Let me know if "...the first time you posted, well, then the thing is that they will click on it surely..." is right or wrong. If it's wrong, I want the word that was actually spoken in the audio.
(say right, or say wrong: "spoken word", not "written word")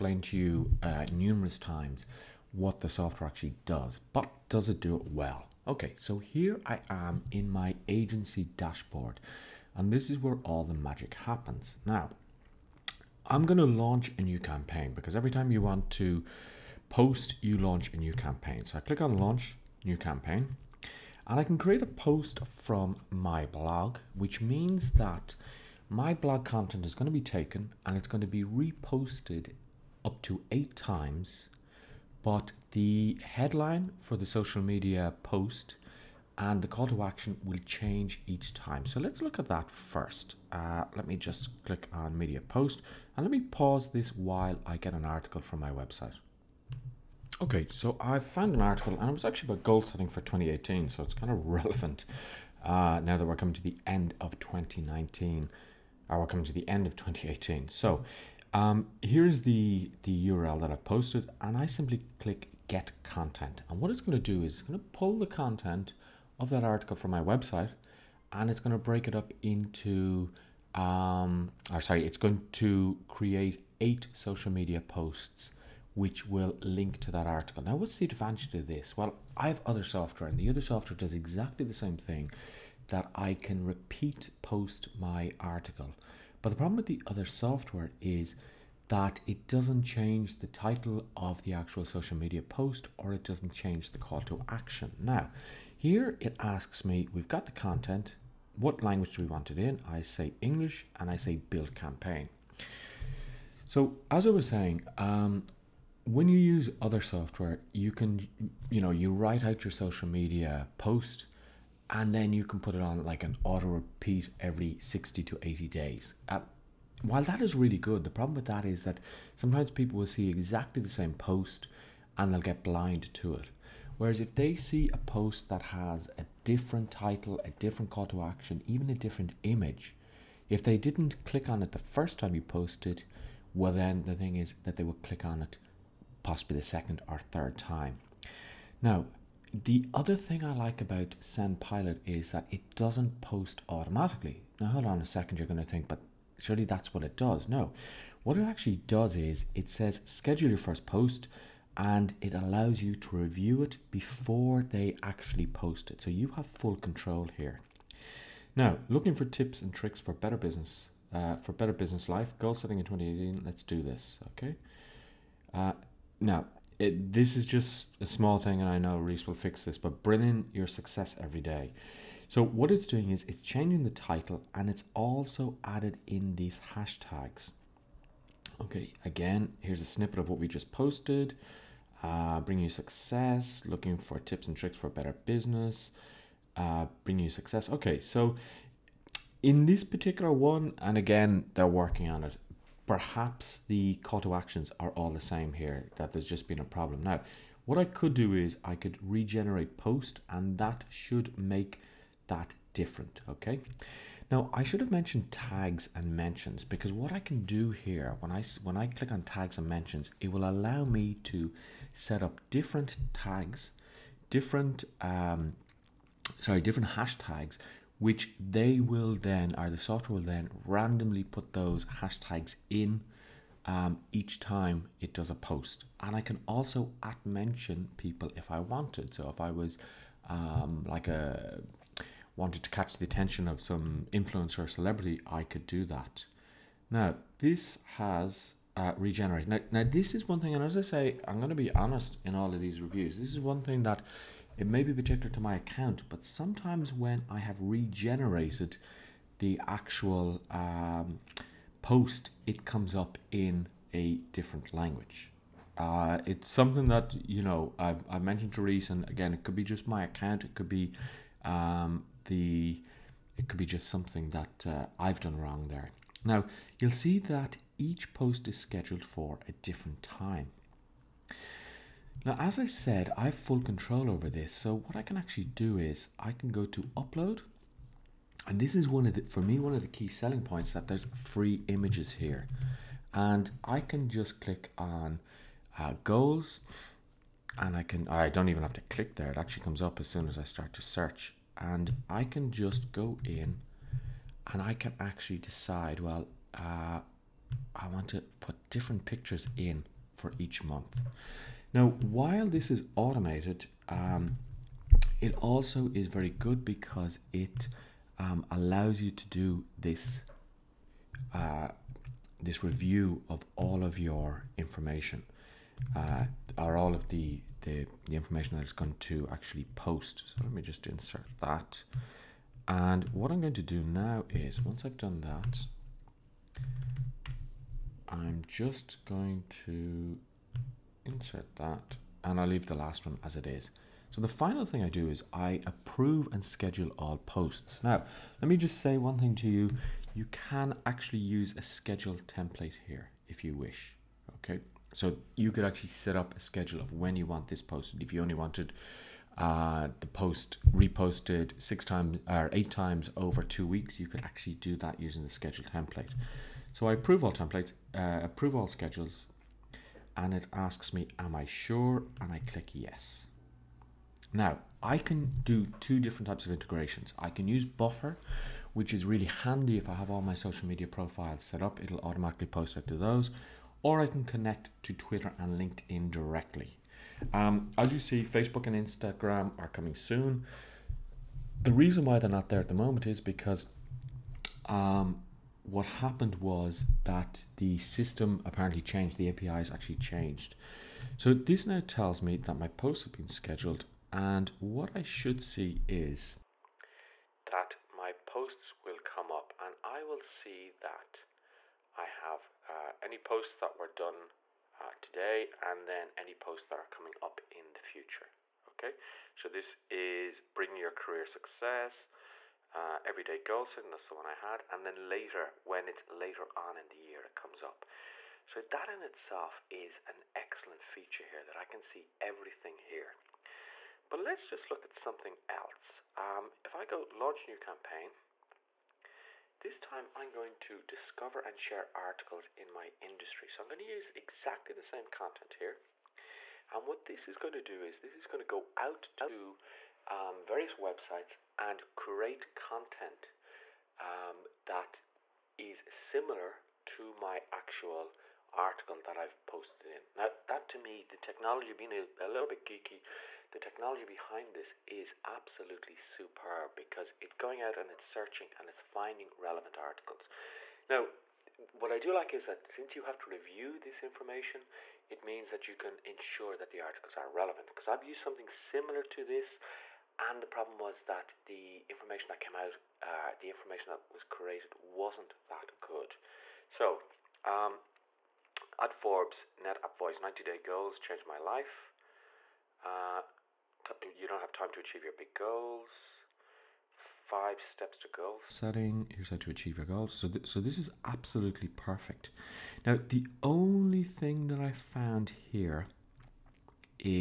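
wrong: "possibly", not "surely".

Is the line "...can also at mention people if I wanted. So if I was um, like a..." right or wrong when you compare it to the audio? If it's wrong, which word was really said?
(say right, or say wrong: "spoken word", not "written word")
right.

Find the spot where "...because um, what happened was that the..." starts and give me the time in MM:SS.
06:23.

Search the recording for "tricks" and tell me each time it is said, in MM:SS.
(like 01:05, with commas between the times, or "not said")
02:39, 03:04.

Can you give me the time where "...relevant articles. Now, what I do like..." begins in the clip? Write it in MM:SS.
07:39.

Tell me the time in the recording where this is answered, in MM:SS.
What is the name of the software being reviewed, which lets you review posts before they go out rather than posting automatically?
02:21.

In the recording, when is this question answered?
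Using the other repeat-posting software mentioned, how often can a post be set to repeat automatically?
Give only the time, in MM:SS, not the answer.
01:54.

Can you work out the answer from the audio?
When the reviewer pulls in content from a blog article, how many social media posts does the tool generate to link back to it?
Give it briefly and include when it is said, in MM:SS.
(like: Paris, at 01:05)
8, at 01:13.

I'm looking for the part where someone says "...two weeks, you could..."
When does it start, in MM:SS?
05:53.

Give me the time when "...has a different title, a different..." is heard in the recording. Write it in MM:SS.
02:05.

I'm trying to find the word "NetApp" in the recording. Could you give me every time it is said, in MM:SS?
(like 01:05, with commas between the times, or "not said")
07:59.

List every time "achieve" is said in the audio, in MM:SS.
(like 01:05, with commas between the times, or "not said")
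08:04, 08:09.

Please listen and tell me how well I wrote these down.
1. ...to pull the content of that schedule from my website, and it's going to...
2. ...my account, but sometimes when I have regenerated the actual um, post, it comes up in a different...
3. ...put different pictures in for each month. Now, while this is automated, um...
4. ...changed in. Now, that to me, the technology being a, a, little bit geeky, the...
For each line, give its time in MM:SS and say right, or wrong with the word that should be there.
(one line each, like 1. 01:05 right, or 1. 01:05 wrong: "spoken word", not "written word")
1. 01:04 wrong: "article", not "schedule"
2. 04:05 right
3. 04:58 right
4. 07:29 wrong: "posted", not "changed".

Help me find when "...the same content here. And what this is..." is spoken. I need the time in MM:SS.
07:14.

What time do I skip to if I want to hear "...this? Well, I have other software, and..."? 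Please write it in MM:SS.
01:18.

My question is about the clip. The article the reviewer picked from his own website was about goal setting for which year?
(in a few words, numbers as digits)
2018.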